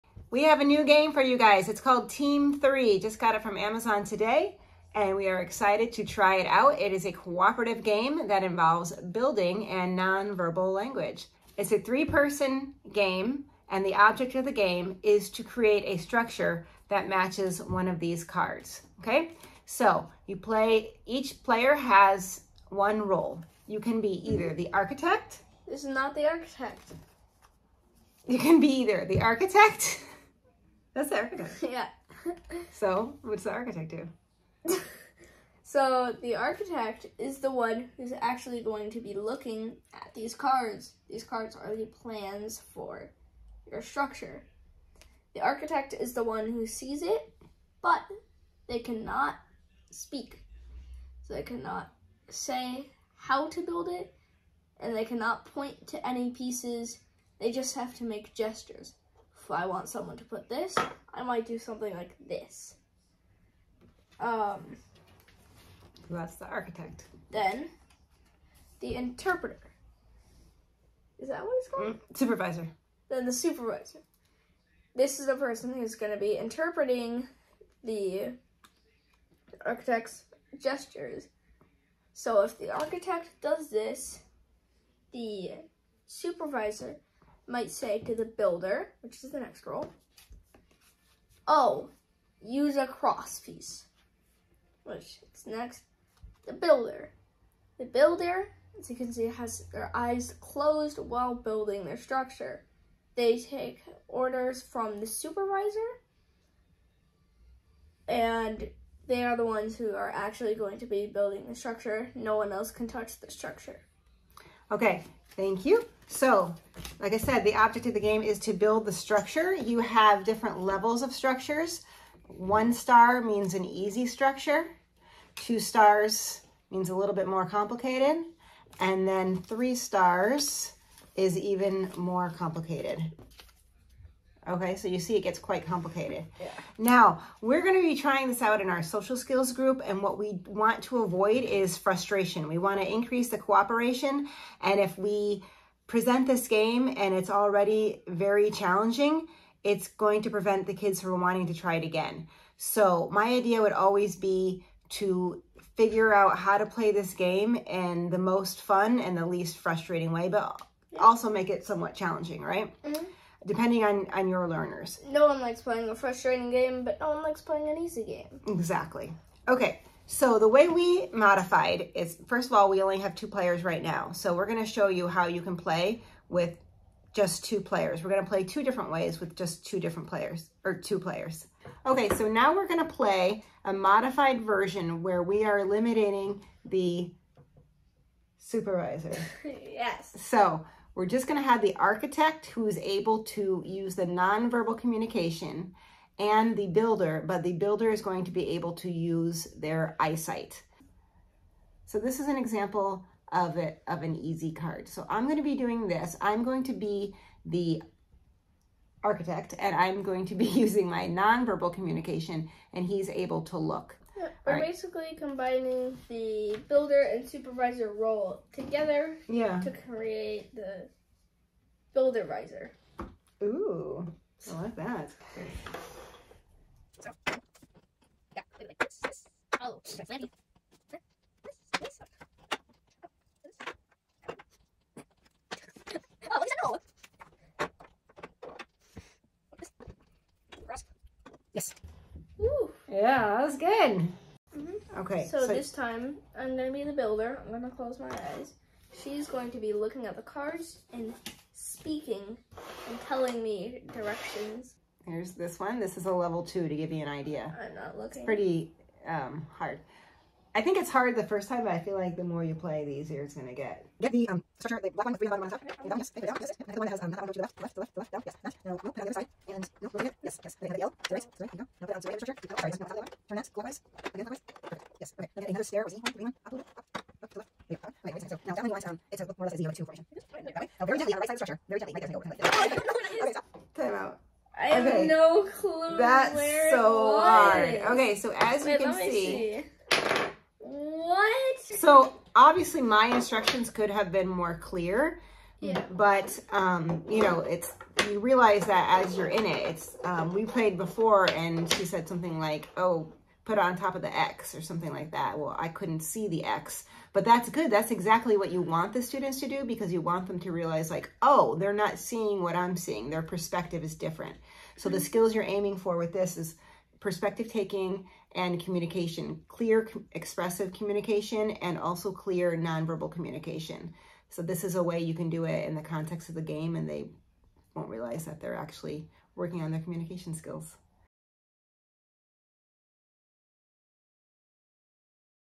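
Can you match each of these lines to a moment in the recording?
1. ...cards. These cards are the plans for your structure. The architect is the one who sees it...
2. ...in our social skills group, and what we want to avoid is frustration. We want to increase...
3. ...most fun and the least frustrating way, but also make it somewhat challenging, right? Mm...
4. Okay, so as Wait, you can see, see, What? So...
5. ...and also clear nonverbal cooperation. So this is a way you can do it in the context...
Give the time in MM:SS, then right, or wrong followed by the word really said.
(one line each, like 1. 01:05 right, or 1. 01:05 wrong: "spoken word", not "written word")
1. 00:40 right
2. 02:18 right
3. 02:38 right
4. 04:47 right
5. 05:21 wrong: "communication", not "cooperation".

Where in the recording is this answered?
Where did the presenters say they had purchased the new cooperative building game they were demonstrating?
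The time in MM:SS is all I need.
00:03.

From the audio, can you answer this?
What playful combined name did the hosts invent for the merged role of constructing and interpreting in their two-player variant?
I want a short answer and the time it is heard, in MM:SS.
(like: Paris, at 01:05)
Buildervisor, at 03:41.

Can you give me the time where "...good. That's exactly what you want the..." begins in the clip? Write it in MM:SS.
05:07.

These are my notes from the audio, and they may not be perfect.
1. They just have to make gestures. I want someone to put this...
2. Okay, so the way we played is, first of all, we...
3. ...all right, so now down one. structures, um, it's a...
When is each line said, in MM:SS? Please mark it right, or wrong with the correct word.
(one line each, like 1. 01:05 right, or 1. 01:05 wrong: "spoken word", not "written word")
1. 00:57 right
2. 02:49 wrong: "modified", not "played"
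3. 04:37 wrong: "lines", not "structures".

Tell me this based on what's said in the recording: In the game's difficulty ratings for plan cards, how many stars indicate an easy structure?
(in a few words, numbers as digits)
1.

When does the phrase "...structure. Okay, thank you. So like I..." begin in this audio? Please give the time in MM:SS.
01:53.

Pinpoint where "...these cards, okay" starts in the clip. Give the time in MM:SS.
00:17.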